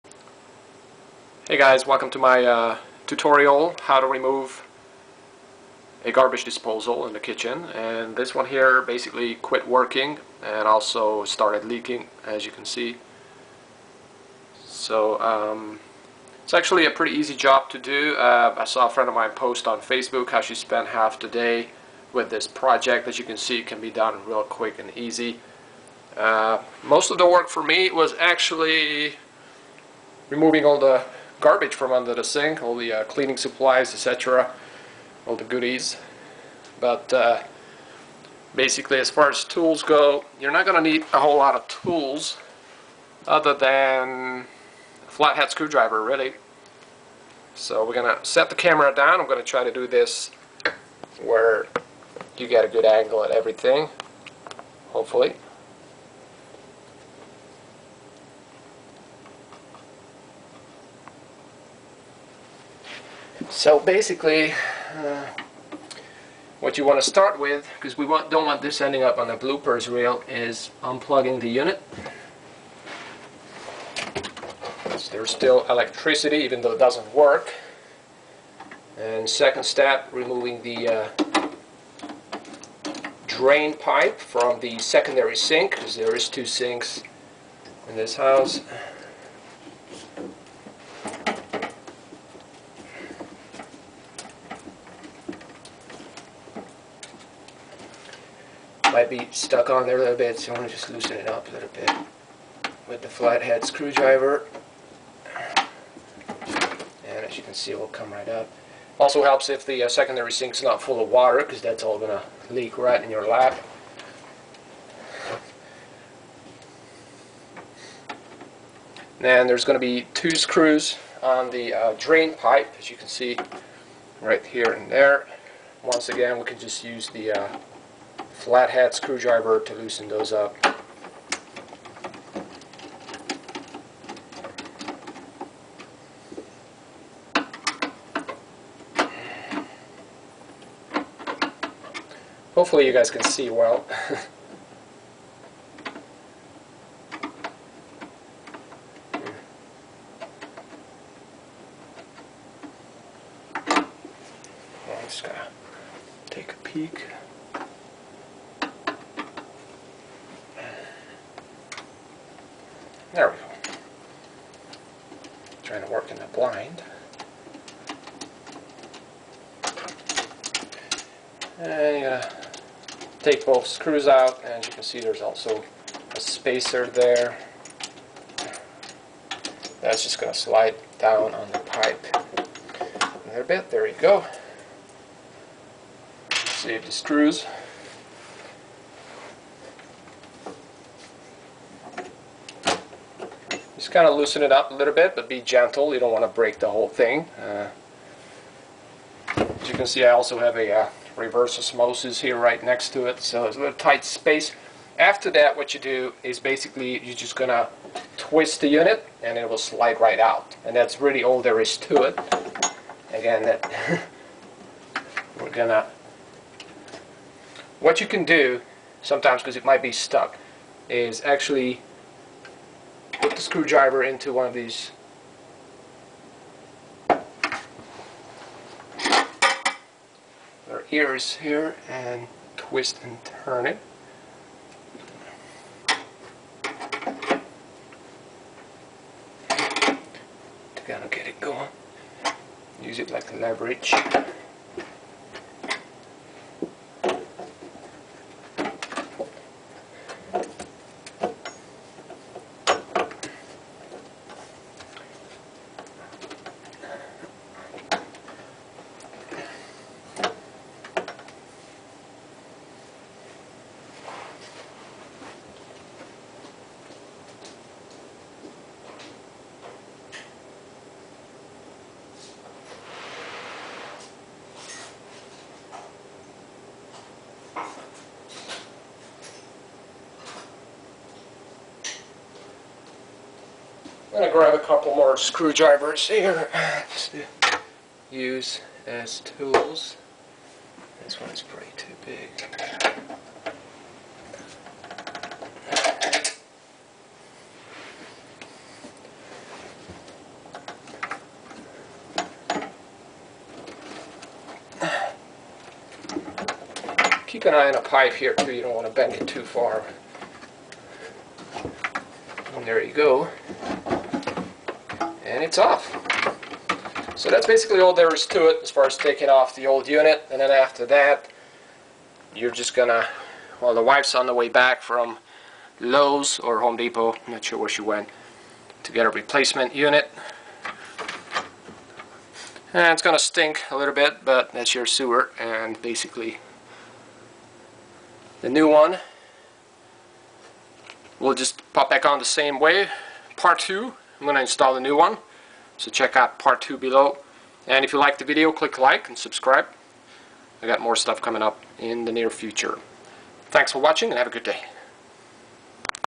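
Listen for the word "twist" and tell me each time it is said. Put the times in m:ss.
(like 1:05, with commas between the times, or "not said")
3:28, 3:52.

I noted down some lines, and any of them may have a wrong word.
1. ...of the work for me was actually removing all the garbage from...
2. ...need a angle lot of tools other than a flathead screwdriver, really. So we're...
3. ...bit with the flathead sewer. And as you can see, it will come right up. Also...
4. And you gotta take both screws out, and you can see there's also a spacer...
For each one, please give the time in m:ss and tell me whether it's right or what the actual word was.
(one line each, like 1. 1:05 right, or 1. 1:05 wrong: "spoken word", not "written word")
1. 0:27 right
2. 0:40 wrong: "whole", not "angle"
3. 1:41 wrong: "screwdriver", not "sewer"
4. 2:51 right.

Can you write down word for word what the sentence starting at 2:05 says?
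Once again, we can just use the uh, flathead screwdriver to loosen those up.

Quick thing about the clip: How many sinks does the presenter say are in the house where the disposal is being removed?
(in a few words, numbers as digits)
2.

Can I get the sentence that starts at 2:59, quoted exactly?
That's just gonna slide down on the pipe.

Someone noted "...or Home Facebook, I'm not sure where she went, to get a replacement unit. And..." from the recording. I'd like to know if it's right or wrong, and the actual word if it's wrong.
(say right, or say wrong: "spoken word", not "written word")
wrong: "Depot", not "Facebook".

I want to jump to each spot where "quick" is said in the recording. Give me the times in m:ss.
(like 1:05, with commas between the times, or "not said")
0:24.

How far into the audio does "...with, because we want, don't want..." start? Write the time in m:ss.
1:07.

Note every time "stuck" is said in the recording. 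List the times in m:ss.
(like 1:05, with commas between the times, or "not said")
1:39, 3:39.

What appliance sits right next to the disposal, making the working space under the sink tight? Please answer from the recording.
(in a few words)
reverse osmosis.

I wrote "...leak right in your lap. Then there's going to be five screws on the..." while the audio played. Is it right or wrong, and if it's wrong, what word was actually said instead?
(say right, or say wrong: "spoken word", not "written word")
wrong: "two", not "five".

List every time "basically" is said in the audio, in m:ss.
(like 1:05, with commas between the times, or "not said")
0:08, 0:38, 1:03, 3:26, 5:17, 5:35.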